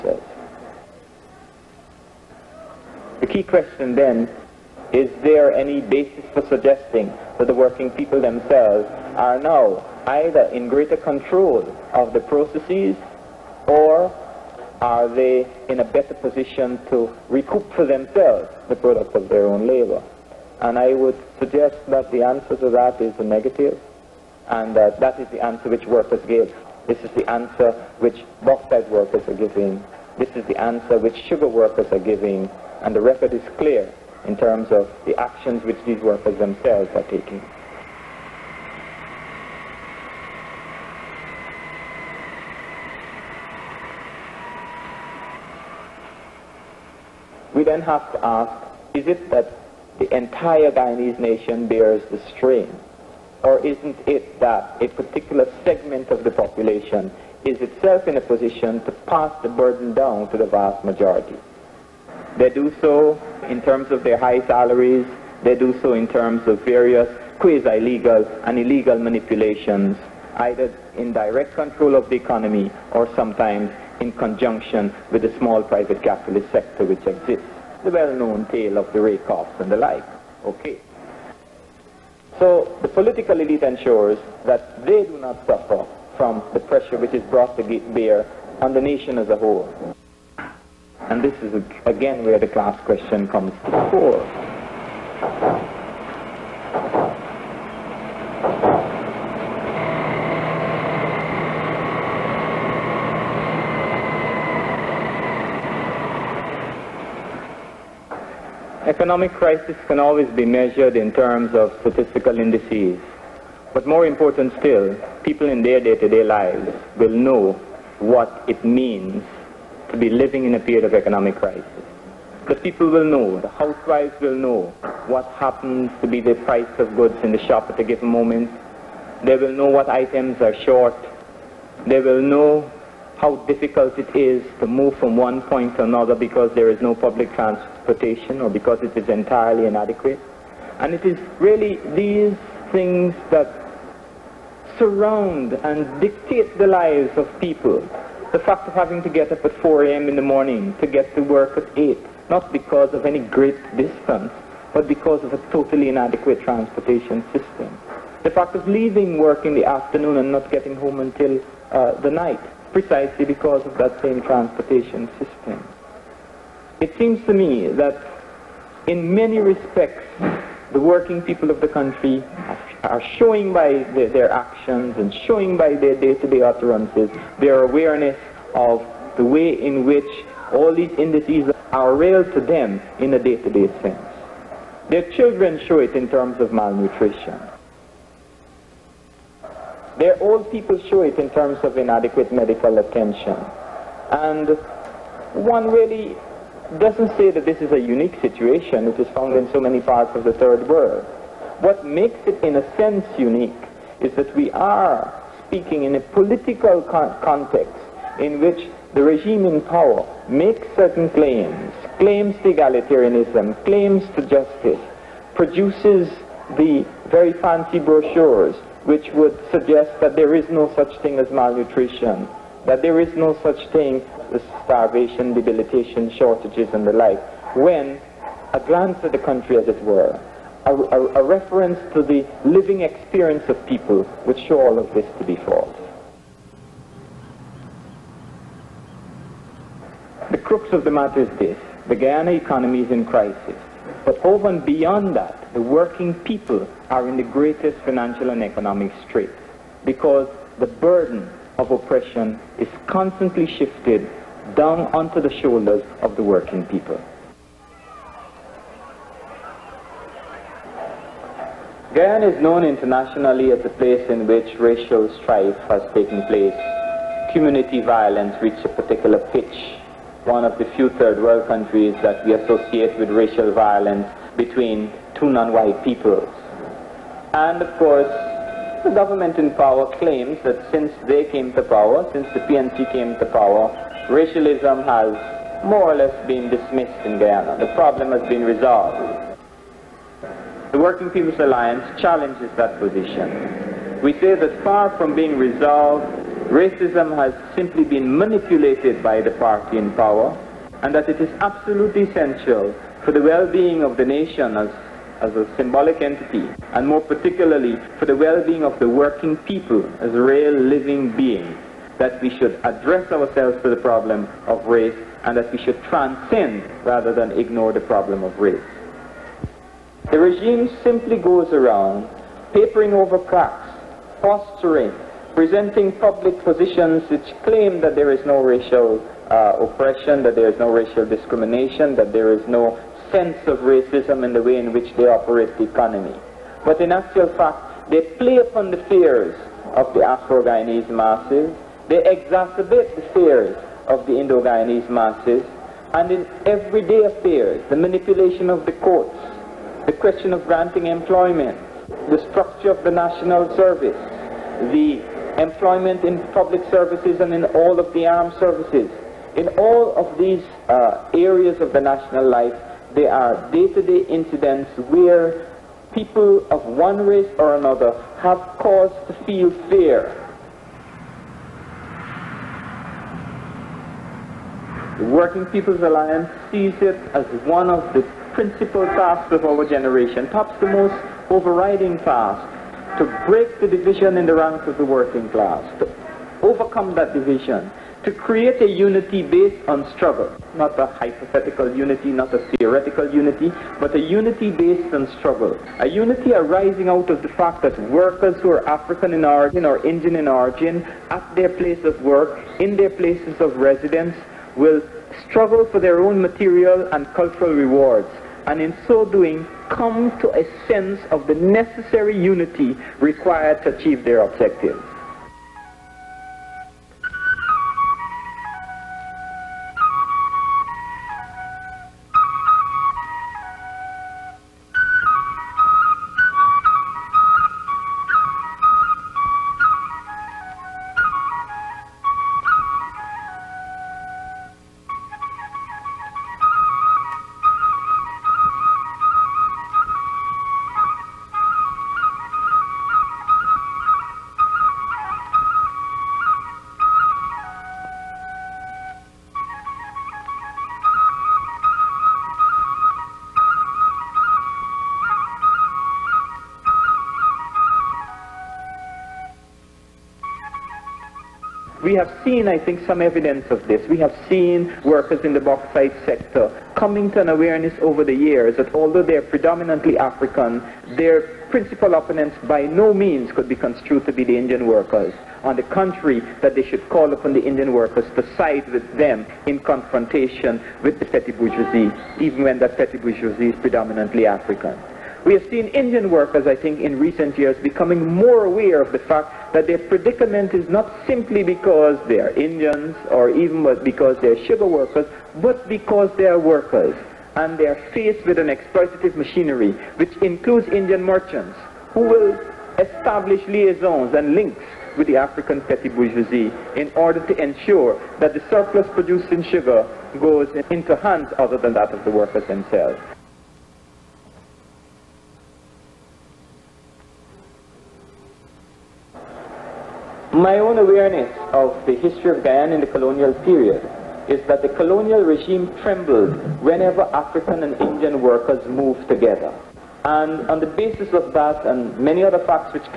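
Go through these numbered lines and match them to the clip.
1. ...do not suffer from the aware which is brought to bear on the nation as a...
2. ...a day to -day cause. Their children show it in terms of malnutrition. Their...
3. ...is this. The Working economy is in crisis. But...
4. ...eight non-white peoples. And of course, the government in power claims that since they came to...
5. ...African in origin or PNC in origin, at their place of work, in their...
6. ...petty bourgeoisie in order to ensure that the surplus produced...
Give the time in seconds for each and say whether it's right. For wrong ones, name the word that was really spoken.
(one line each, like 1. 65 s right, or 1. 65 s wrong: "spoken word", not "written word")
1. 85 s wrong: "pressure", not "aware"
2. 183 s wrong: "sense", not "cause"
3. 241 s wrong: "Guyana", not "Working"
4. 275 s wrong: "two", not "eight"
5. 398 s wrong: "Indian", not "PNC"
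6. 505 s right.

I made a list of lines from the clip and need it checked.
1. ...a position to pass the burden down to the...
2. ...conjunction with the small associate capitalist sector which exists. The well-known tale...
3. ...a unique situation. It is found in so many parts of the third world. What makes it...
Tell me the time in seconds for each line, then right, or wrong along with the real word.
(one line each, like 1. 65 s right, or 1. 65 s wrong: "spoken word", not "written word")
1. 58 s right
2. 74 s wrong: "private", not "associate"
3. 197 s right.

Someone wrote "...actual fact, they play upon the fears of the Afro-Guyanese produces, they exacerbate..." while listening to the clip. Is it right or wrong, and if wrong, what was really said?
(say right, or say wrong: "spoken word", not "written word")
wrong: "masses", not "produces".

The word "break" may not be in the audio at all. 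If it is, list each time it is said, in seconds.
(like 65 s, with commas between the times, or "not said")
383 s.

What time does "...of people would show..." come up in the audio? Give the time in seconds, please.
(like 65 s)
233 s.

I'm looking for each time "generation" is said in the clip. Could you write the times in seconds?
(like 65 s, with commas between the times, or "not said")
379 s.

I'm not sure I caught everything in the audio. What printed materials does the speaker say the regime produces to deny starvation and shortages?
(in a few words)
Fancy brochures.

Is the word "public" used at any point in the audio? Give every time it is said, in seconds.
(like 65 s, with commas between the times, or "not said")
136 s, 325 s, 356 s.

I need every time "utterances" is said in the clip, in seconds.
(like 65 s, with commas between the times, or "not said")
176 s.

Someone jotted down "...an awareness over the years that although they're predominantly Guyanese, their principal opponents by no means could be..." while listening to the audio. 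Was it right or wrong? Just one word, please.
wrong.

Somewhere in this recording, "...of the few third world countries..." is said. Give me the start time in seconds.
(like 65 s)
270 s.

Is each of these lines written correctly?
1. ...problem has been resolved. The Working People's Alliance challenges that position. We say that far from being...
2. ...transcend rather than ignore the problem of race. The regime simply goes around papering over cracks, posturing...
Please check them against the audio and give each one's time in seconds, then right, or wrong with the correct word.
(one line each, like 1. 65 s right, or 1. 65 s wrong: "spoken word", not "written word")
1. 287 s right
2. 315 s right.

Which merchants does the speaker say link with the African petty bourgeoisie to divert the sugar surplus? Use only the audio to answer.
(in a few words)
Indian merchants.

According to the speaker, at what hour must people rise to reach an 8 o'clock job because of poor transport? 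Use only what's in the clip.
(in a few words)
4 a.m.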